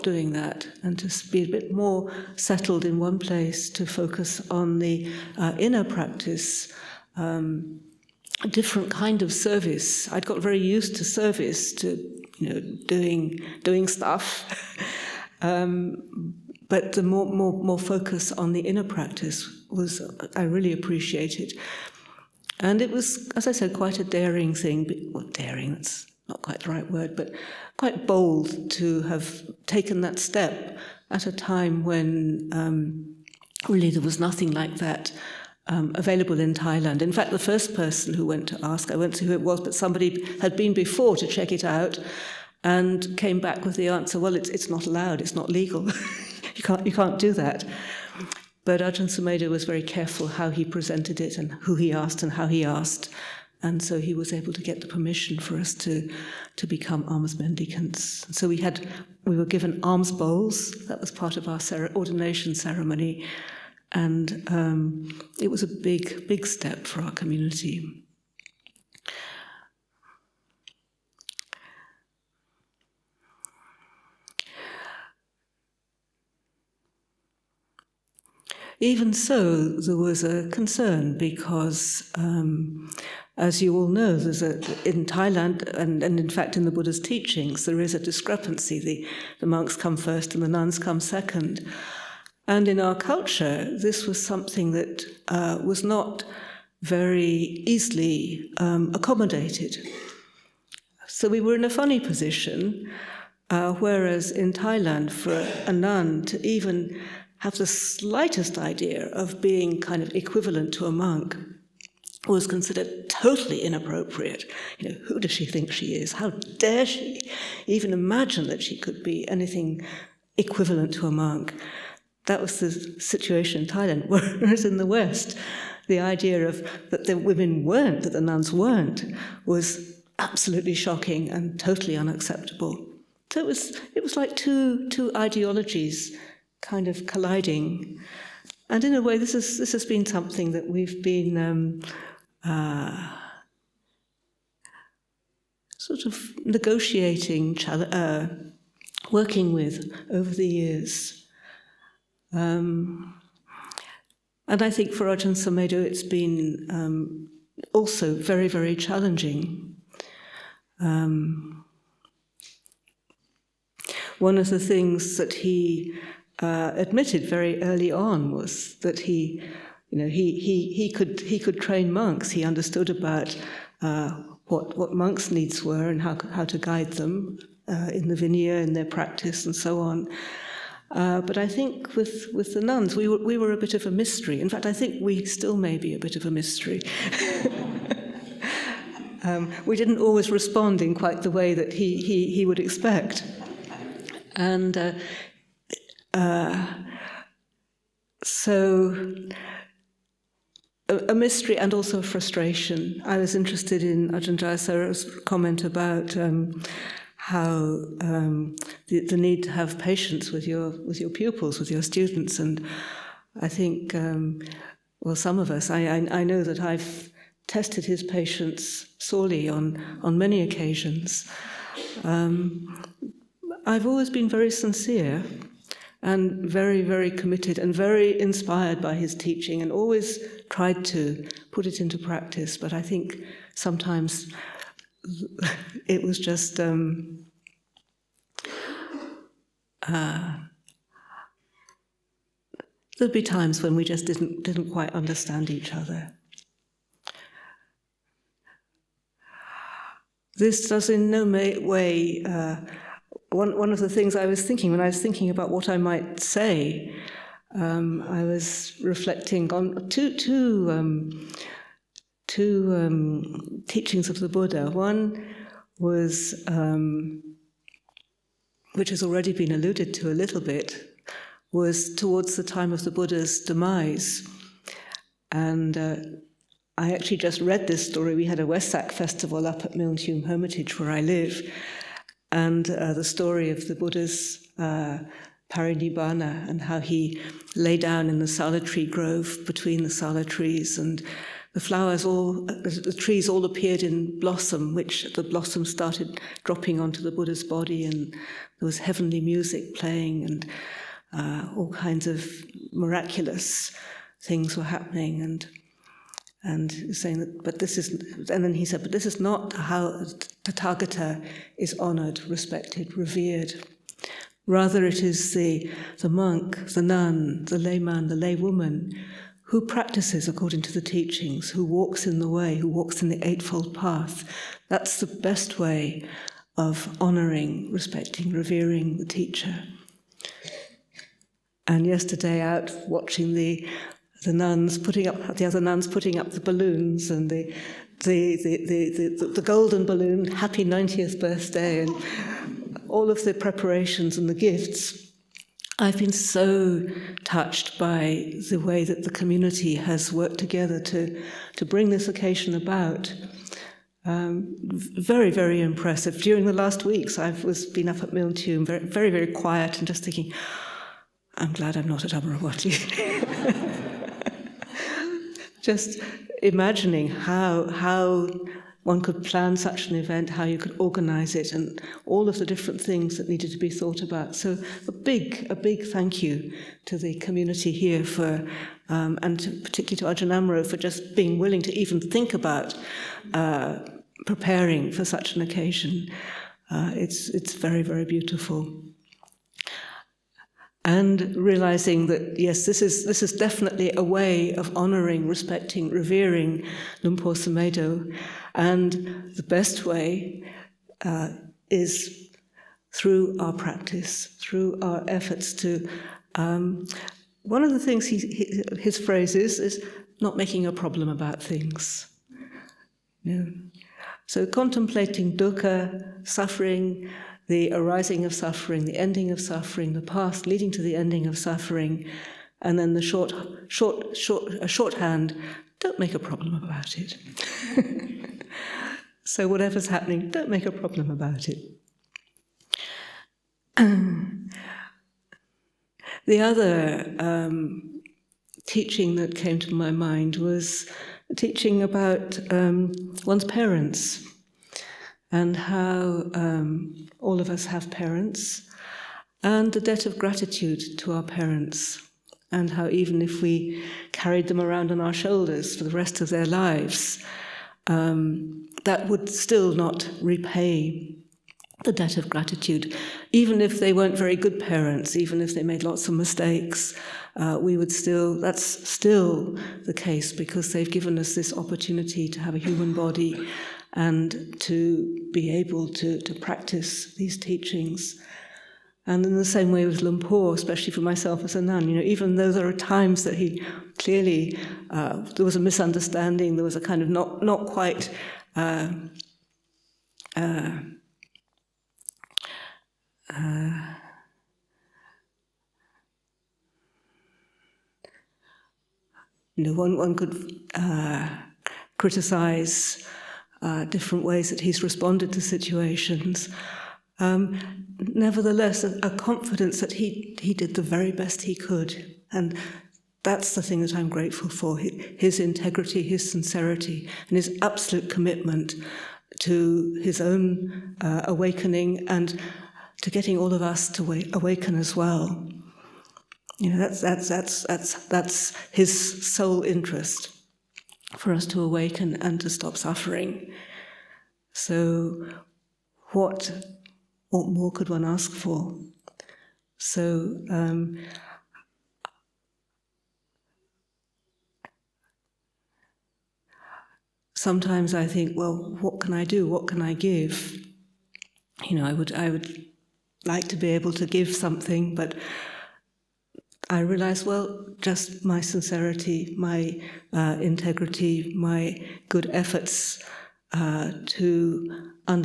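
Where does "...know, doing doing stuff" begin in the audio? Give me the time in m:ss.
0:12.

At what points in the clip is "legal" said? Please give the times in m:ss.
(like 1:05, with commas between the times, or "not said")
0:45.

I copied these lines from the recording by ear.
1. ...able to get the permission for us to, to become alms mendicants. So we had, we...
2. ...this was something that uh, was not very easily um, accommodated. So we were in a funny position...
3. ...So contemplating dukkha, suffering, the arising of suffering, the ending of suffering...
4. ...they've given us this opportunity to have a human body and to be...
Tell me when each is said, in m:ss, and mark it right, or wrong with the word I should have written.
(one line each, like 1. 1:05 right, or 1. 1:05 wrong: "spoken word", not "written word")
1. 0:54 right
2. 1:33 right
3. 6:54 right
4. 7:50 right.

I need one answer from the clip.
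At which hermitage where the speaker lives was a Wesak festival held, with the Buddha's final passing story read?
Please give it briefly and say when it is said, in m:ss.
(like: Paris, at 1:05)
Milntuim Hermitage, at 4:39.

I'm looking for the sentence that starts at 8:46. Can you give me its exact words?
You know, that's, that's, that's, that's, that's his sole interest for us to awaken and to stop suffering.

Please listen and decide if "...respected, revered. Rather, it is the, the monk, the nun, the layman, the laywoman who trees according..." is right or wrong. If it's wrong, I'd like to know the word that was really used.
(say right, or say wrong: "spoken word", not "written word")
wrong: "practices", not "trees".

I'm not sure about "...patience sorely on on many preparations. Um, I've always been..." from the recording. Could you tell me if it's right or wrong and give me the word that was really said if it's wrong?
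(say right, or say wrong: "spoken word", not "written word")
wrong: "occasions", not "preparations".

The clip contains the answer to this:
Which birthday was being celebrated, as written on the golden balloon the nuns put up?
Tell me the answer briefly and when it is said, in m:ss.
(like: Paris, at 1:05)
90th, at 5:40.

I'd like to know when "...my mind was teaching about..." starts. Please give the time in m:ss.
7:19.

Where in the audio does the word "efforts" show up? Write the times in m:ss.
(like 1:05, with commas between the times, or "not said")
6:45, 9:22.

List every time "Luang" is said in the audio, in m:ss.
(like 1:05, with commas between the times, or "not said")
6:37, 8:00.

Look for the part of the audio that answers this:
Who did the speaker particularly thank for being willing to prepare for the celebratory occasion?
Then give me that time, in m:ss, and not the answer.
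6:20.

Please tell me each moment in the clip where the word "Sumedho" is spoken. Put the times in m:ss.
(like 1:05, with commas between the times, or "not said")
0:49, 2:35, 6:37.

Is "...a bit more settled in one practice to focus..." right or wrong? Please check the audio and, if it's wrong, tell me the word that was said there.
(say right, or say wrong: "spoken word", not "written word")
wrong: "place", not "practice".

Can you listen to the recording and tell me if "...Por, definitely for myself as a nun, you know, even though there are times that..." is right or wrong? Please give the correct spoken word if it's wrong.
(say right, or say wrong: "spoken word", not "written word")
wrong: "especially", not "definitely".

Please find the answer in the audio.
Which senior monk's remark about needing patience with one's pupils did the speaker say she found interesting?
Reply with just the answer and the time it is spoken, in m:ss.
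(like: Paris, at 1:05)
Ajahn Jayasaro, at 3:24.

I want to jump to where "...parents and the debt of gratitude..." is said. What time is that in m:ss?
7:27.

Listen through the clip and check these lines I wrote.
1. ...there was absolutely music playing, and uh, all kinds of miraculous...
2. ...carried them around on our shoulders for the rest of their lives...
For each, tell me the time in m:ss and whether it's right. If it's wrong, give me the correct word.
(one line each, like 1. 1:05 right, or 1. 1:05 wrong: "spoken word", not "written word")
1. 4:58 wrong: "heavenly", not "absolutely"
2. 7:34 right.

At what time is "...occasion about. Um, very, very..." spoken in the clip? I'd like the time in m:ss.
5:52.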